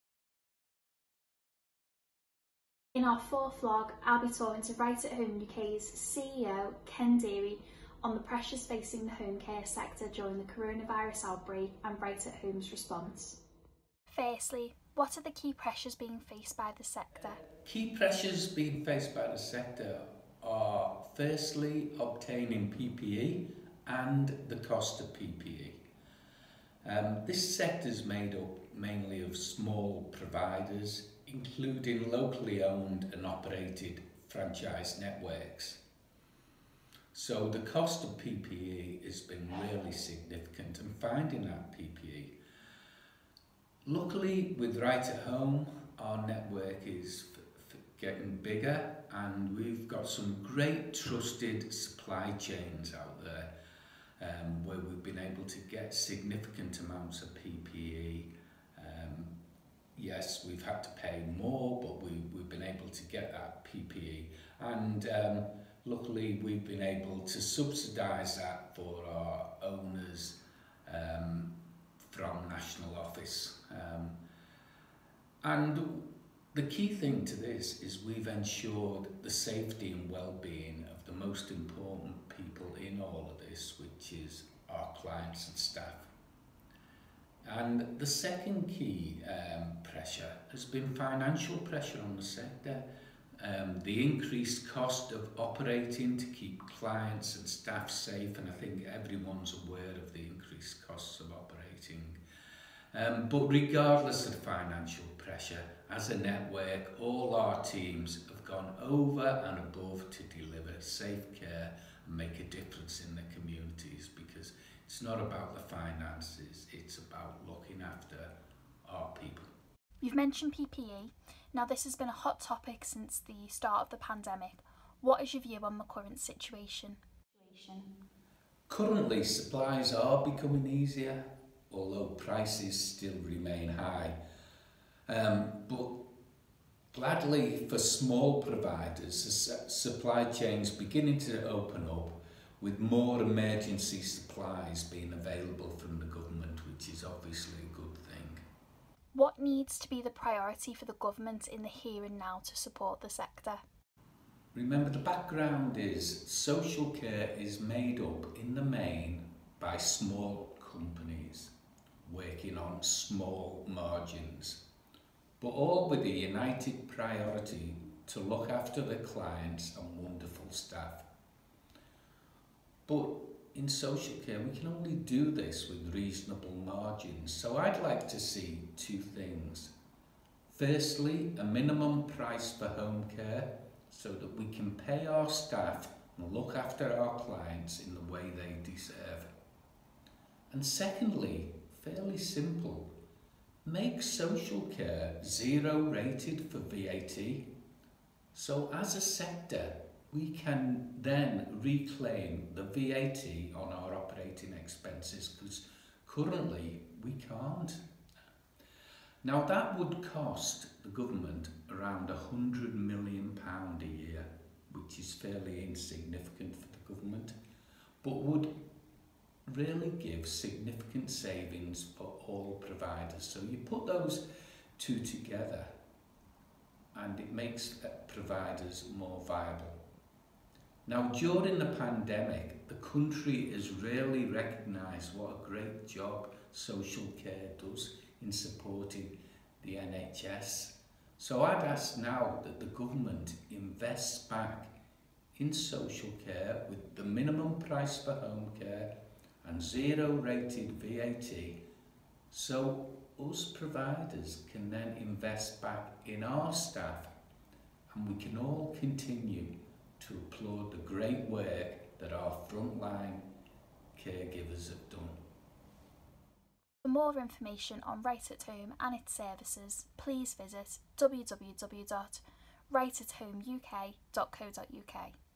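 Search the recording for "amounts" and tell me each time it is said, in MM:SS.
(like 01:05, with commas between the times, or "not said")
00:56.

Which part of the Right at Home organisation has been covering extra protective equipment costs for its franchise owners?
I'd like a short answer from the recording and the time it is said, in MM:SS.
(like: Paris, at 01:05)
National Office, at 01:12.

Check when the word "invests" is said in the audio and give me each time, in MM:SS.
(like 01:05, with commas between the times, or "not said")
04:03, 04:14.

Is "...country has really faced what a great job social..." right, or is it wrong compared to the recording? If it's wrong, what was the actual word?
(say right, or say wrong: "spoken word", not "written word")
wrong: "recognised", not "faced".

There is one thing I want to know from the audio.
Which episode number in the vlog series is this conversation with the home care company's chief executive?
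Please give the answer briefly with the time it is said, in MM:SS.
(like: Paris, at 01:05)
Fourth, at 00:03.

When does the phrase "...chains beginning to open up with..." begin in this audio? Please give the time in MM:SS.
02:20.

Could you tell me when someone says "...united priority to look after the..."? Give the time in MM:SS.
02:46.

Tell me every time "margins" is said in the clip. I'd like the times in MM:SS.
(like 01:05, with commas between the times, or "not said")
02:43, 02:56.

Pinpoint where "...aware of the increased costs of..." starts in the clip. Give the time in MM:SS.
01:39.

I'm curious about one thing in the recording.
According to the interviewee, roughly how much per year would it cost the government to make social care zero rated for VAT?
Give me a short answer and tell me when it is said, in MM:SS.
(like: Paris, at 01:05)
£100 million, at 03:32.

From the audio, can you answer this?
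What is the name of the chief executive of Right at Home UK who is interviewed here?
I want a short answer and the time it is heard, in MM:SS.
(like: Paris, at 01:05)
Ken Deary, at 00:06.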